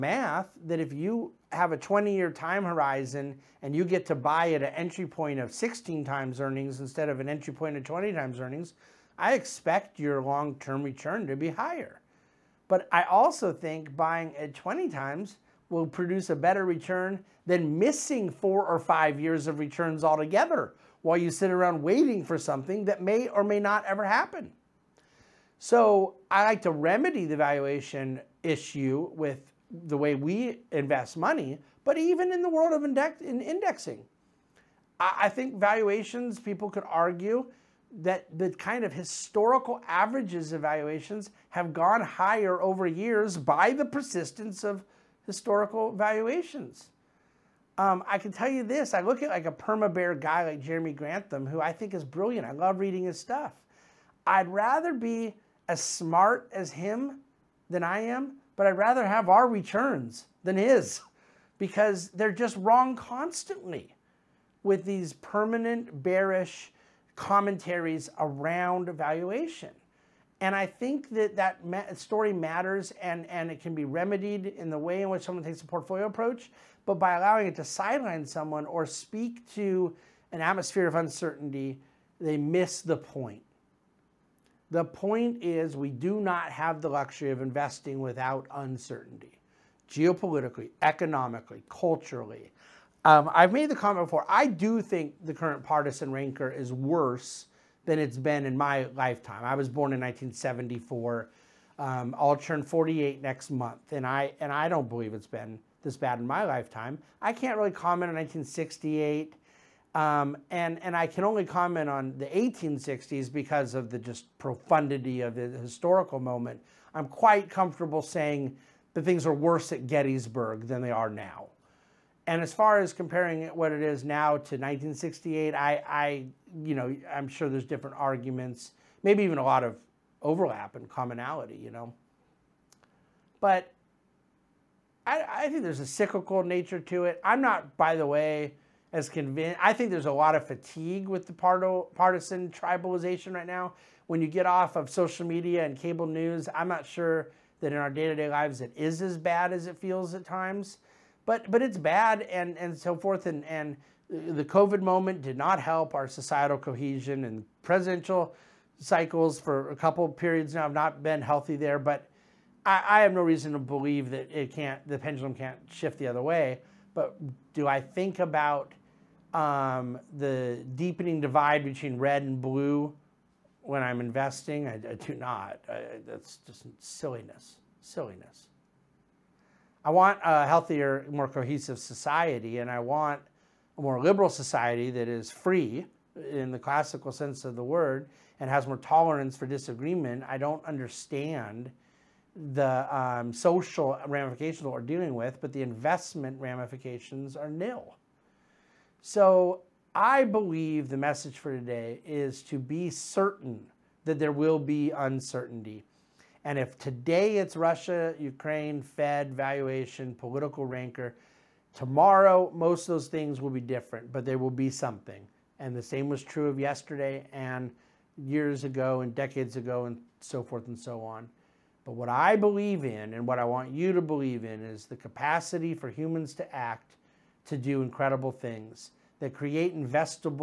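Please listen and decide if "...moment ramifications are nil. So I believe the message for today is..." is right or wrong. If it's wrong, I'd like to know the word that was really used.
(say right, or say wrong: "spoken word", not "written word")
wrong: "investment", not "moment".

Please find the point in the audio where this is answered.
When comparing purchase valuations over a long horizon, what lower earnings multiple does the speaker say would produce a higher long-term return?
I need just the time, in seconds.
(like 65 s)
5 s.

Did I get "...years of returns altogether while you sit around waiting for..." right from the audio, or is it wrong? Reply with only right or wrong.
right.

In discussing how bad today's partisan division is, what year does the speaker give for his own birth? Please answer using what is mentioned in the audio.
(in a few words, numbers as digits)
1974.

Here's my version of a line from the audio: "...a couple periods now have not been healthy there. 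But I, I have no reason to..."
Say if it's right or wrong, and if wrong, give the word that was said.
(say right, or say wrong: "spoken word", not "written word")
right.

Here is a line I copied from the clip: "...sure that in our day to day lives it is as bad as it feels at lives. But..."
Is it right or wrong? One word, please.
wrong.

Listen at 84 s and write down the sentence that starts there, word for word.
The point is, we do not have the luxury of investing without uncertainty, geopolitically, economically, culturally.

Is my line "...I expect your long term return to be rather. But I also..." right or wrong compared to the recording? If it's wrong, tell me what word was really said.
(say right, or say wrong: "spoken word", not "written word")
wrong: "higher", not "rather".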